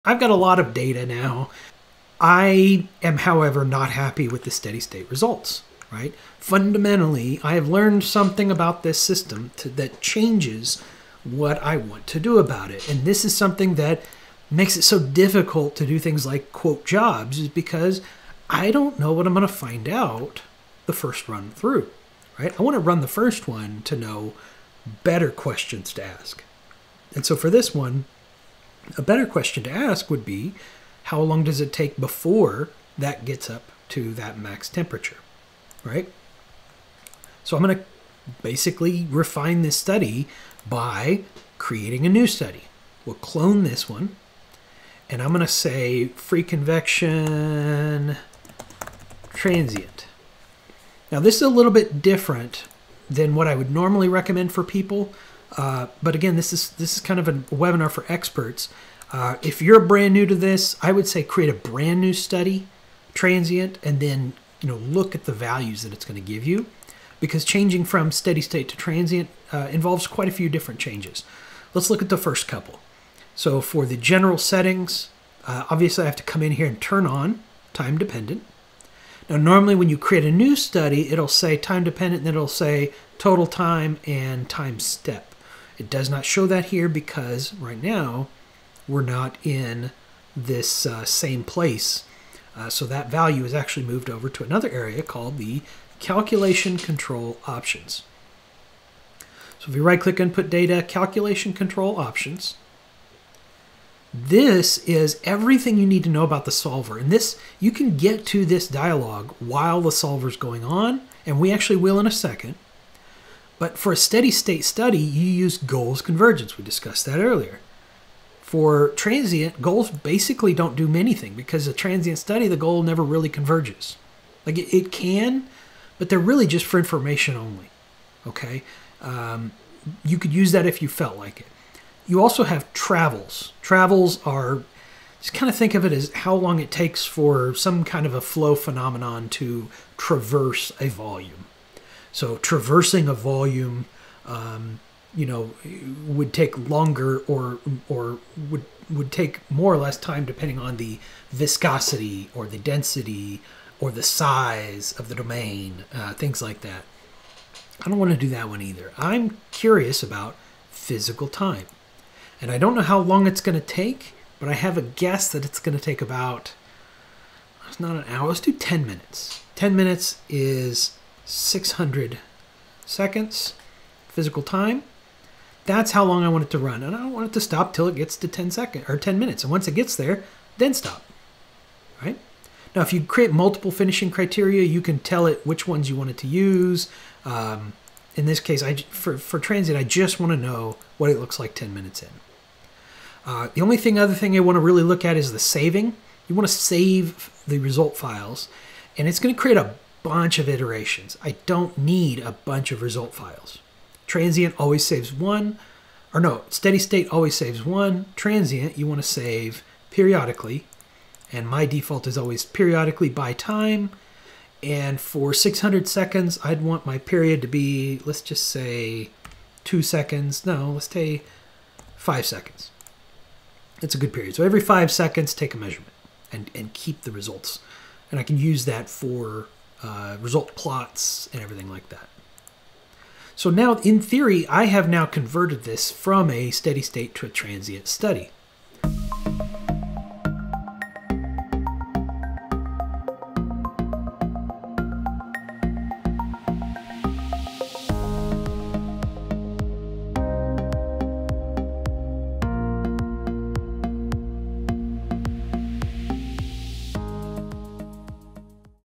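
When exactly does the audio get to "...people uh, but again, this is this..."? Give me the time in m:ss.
0:54.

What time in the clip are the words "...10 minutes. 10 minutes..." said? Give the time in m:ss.
2:48.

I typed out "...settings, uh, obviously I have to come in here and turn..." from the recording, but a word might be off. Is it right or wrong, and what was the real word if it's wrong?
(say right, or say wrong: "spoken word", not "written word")
right.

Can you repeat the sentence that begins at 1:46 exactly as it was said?
And this, you can get to this dialog while the solver is going on, and we actually will in a second.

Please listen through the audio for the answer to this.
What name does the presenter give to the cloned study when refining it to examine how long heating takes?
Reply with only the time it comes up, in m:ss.
0:46.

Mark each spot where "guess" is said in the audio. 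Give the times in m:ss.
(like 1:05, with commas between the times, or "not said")
2:44.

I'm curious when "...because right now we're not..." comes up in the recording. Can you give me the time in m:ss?
1:26.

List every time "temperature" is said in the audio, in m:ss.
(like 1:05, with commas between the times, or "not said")
0:34.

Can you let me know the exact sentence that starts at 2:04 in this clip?
Like it, it can, but they're really just for information only.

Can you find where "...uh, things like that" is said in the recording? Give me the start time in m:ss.
2:35.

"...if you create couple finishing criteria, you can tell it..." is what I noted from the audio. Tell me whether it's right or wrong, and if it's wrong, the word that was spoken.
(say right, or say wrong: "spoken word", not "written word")
wrong: "multiple", not "couple".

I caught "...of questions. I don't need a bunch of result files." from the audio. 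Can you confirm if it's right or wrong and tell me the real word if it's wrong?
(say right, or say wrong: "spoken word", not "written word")
wrong: "iterations", not "questions".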